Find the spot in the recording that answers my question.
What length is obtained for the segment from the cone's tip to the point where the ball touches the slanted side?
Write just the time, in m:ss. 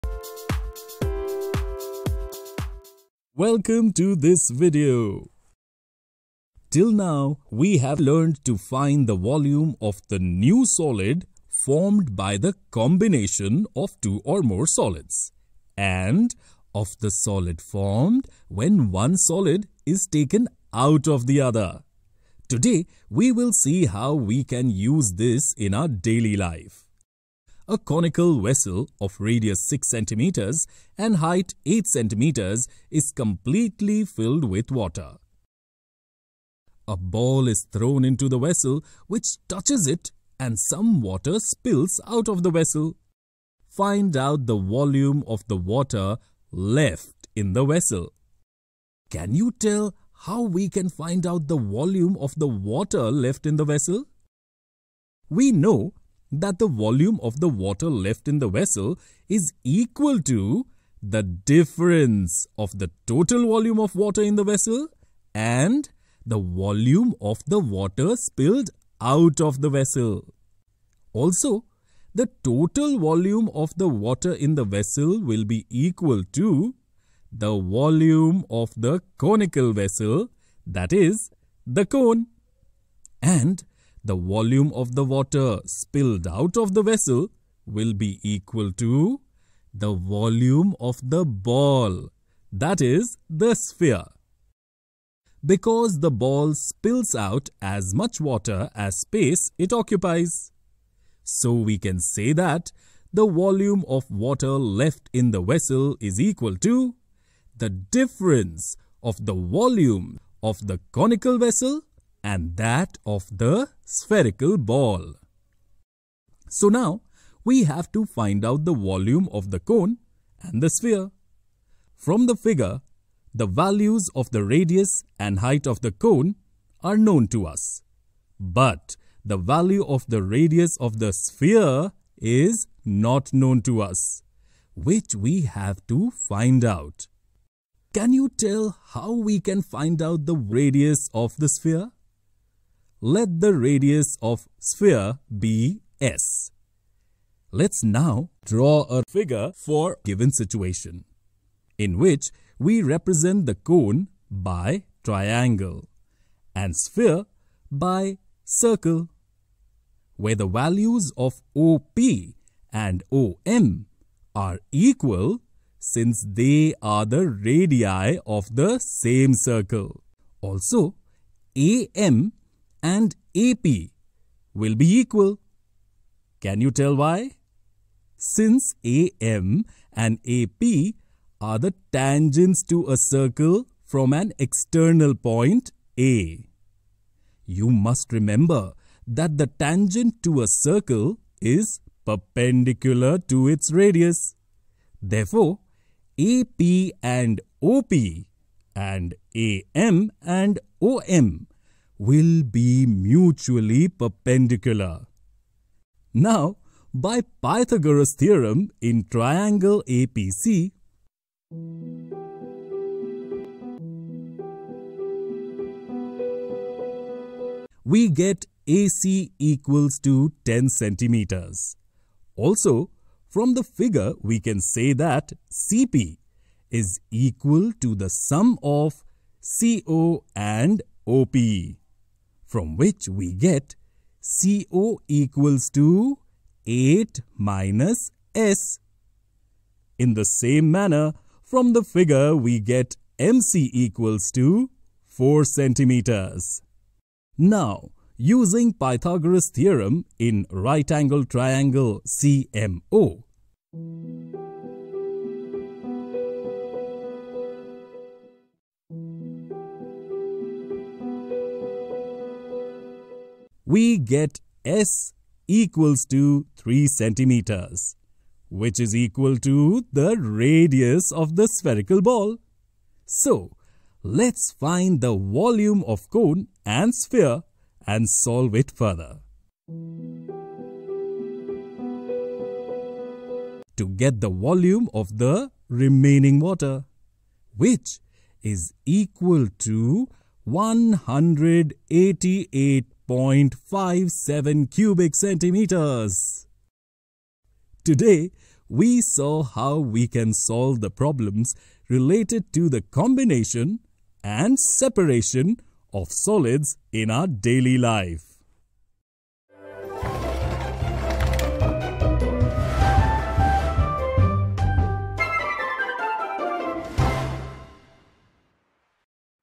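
4:05.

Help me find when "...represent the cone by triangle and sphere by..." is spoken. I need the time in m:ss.
2:32.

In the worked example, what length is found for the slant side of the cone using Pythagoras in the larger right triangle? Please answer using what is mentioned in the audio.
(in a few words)
10 centimeters.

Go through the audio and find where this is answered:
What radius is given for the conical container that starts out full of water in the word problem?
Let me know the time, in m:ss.
0:29.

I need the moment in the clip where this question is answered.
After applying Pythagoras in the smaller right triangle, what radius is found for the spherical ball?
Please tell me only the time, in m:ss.
4:26.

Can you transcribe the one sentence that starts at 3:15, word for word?
Therefore, AP and OP and AM and OM will be mutually perpendicular.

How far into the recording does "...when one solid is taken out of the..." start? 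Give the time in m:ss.
0:18.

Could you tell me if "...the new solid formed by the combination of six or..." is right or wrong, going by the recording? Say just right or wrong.
wrong.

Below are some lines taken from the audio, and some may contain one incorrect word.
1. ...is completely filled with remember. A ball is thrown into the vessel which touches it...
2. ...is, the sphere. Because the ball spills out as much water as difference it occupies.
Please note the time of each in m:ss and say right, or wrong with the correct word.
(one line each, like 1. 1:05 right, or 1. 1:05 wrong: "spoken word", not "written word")
1. 0:32 wrong: "water", not "remember"
2. 1:32 wrong: "space", not "difference".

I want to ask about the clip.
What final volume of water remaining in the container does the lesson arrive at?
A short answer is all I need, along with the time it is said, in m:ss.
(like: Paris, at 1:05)
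188.57 cubic centimeters, at 4:50.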